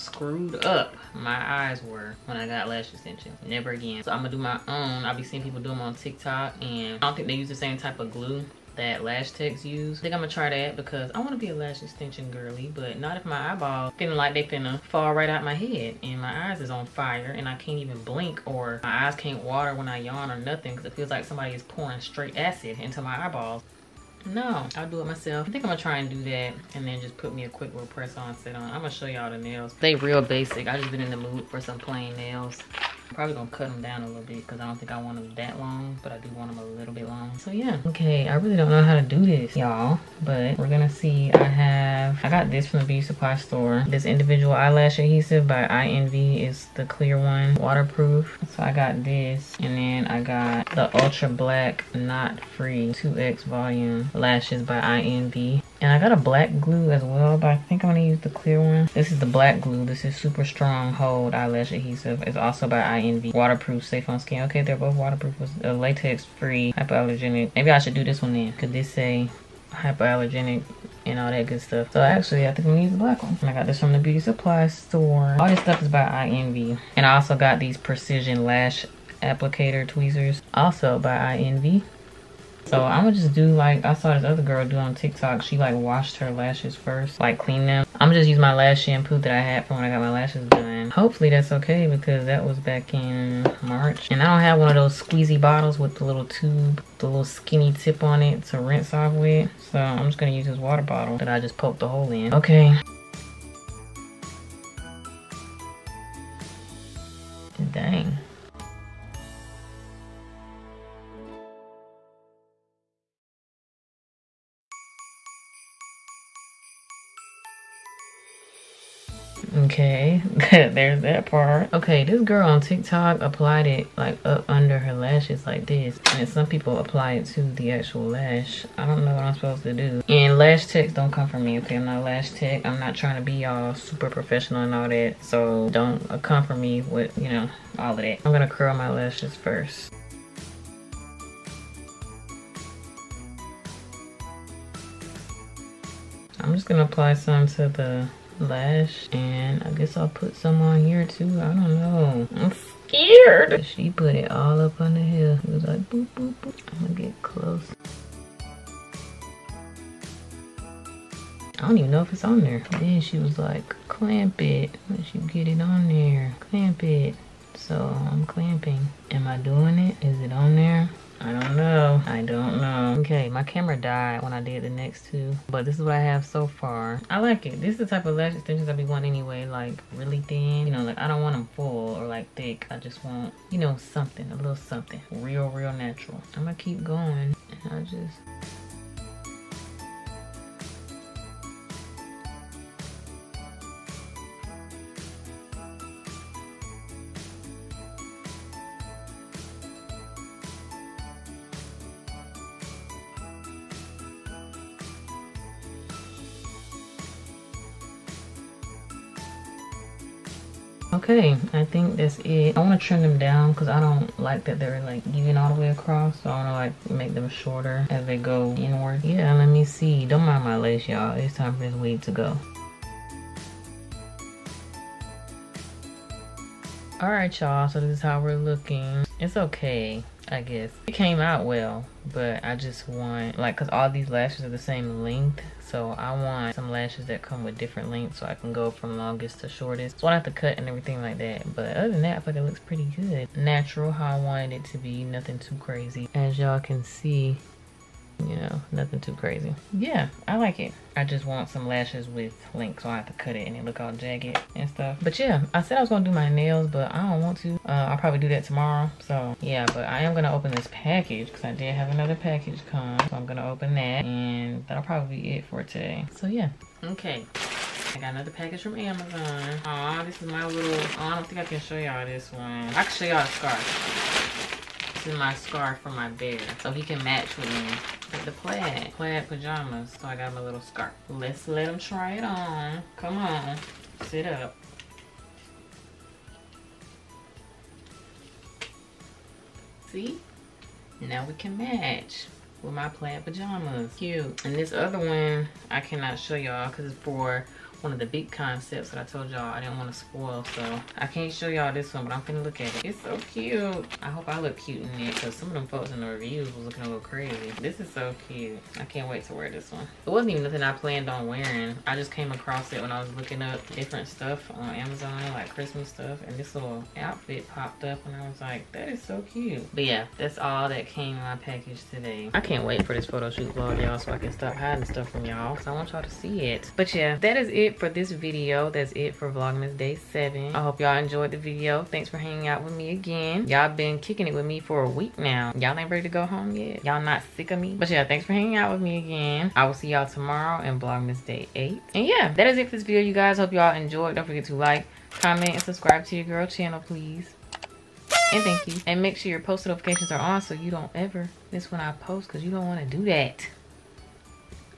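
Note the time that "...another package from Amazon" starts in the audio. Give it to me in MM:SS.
04:28.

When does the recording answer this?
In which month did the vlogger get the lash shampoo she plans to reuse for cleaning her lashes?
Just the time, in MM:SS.
01:33.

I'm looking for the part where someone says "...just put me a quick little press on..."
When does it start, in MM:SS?
00:27.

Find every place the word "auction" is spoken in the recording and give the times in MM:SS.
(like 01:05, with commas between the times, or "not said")
not said.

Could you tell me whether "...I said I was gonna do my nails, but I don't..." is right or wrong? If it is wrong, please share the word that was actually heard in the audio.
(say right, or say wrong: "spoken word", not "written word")
right.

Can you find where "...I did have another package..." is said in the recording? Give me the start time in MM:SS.
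04:21.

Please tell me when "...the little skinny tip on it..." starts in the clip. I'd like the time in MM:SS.
01:36.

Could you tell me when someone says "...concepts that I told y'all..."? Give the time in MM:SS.
04:58.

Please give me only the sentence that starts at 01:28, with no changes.
I'ma just use my lash shampoo that I had from when I got my lashes done.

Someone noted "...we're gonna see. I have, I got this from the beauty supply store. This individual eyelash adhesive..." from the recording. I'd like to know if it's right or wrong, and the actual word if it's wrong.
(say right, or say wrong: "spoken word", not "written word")
right.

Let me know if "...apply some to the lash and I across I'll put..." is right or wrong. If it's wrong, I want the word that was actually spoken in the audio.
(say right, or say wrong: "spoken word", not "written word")
wrong: "guess", not "across".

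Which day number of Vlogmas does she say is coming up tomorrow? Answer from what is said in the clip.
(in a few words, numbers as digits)
8.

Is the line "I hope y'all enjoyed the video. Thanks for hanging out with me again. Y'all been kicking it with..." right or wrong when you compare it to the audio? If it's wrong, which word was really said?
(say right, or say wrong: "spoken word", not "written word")
right.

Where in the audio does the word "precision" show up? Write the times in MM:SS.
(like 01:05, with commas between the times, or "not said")
01:17.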